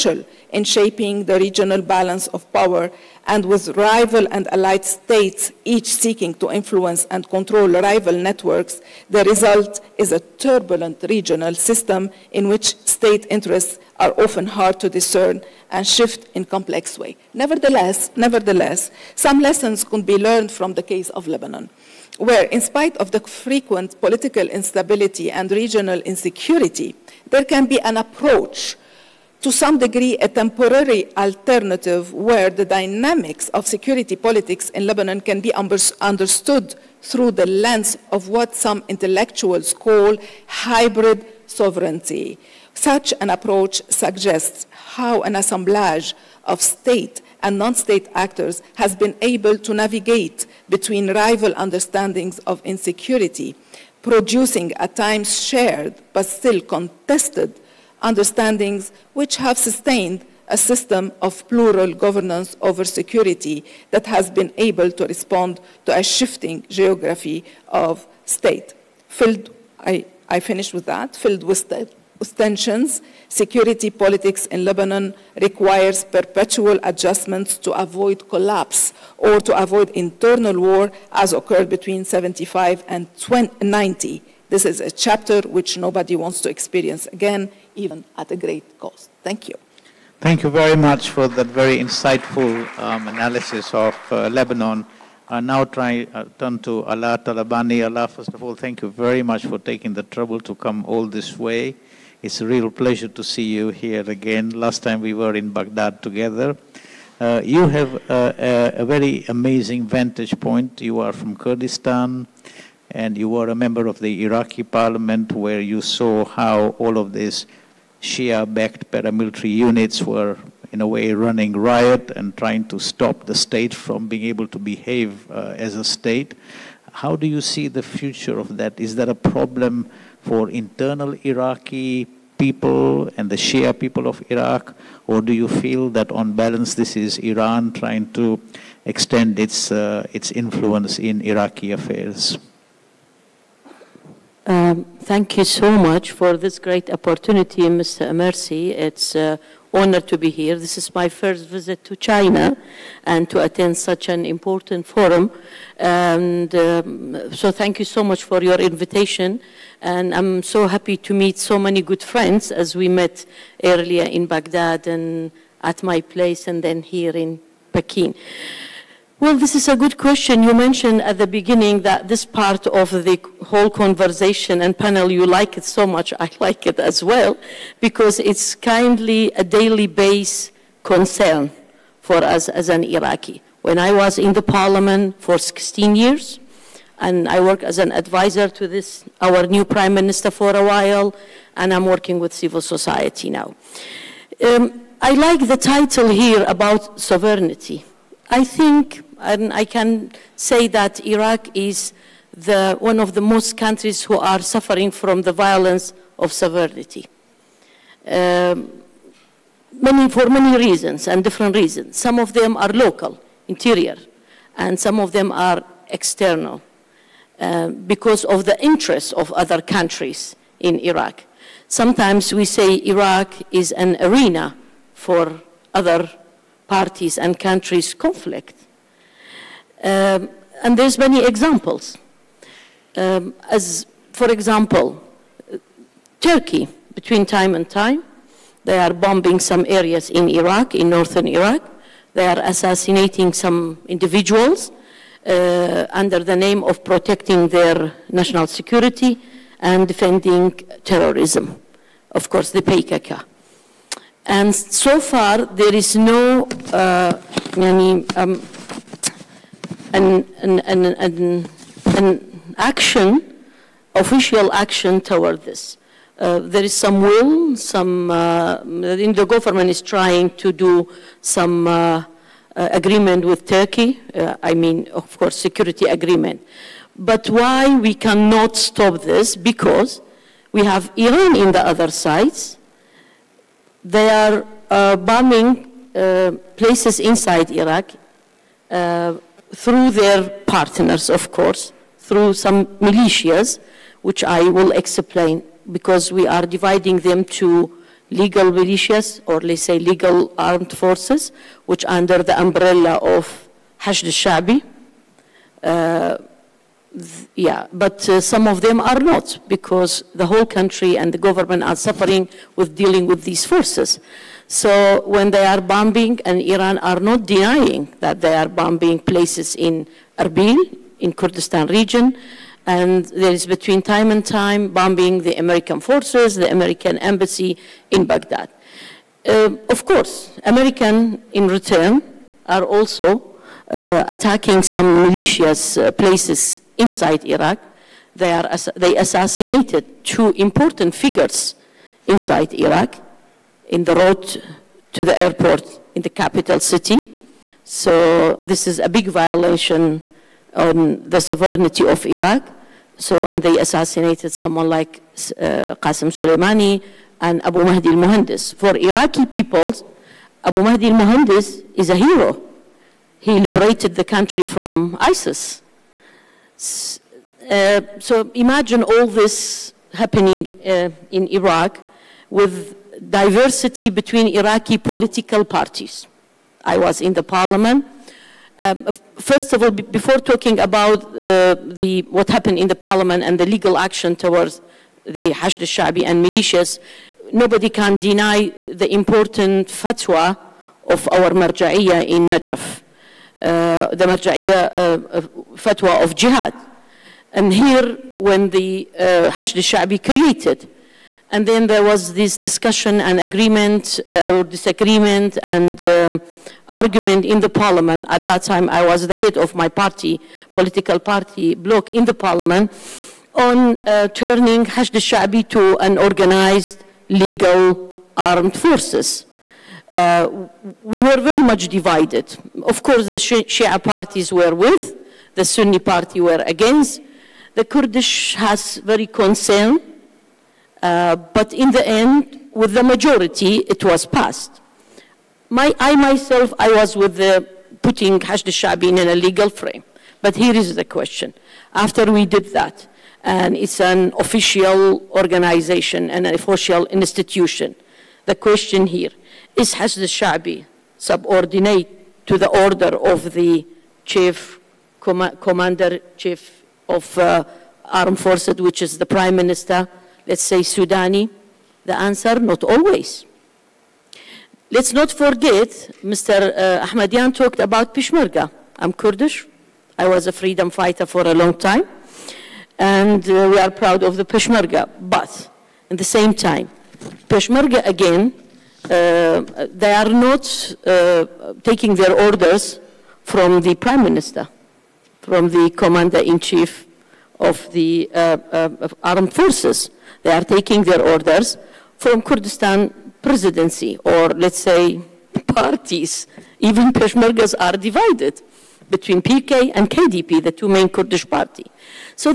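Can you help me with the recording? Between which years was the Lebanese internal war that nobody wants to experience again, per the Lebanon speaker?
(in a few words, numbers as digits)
75 and 90.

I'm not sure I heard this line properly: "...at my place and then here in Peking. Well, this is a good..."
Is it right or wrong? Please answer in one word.
right.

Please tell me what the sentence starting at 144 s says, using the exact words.
Um, thank you so much for this great opportunity, Mr.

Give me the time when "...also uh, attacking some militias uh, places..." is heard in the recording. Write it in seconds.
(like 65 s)
332 s.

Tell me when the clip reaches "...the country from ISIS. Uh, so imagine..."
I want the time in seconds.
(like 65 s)
363 s.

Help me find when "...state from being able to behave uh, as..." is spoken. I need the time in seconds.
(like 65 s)
123 s.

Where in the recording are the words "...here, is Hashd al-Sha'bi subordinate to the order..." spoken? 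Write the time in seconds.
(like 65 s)
448 s.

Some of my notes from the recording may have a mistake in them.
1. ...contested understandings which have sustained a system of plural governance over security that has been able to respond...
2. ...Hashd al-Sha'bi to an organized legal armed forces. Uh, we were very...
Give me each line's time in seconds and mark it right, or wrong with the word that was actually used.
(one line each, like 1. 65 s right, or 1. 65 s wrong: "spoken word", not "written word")
1. 56 s right
2. 414 s right.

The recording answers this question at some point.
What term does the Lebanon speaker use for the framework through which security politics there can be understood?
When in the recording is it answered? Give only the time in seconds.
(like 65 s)
40 s.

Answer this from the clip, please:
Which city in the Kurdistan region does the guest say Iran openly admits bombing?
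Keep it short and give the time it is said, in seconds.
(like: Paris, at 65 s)
Erbil, at 320 s.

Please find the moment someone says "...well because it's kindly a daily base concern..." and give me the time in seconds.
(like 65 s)
177 s.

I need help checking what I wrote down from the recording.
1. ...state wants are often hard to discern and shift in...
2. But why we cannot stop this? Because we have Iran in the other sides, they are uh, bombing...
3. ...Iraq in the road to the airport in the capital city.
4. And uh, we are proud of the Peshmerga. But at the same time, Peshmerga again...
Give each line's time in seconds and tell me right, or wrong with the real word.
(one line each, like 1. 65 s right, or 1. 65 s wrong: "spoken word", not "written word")
1. 12 s wrong: "interests", not "wants"
2. 276 s right
3. 342 s right
4. 472 s right.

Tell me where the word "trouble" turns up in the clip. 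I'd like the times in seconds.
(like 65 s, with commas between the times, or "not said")
100 s.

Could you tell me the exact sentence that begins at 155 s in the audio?
And um, so thank you so much for your invitation.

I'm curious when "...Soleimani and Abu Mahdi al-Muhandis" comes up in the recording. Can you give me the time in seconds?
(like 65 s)
356 s.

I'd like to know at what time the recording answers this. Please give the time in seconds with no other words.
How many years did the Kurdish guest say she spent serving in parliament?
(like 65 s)
185 s.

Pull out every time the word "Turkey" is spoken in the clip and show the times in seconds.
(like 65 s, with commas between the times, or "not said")
236 s, 273 s.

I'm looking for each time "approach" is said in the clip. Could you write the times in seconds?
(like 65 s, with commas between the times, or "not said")
27 s, 43 s.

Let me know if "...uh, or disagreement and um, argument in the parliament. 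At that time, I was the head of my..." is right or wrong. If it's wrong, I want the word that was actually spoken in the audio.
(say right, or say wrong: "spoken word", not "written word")
right.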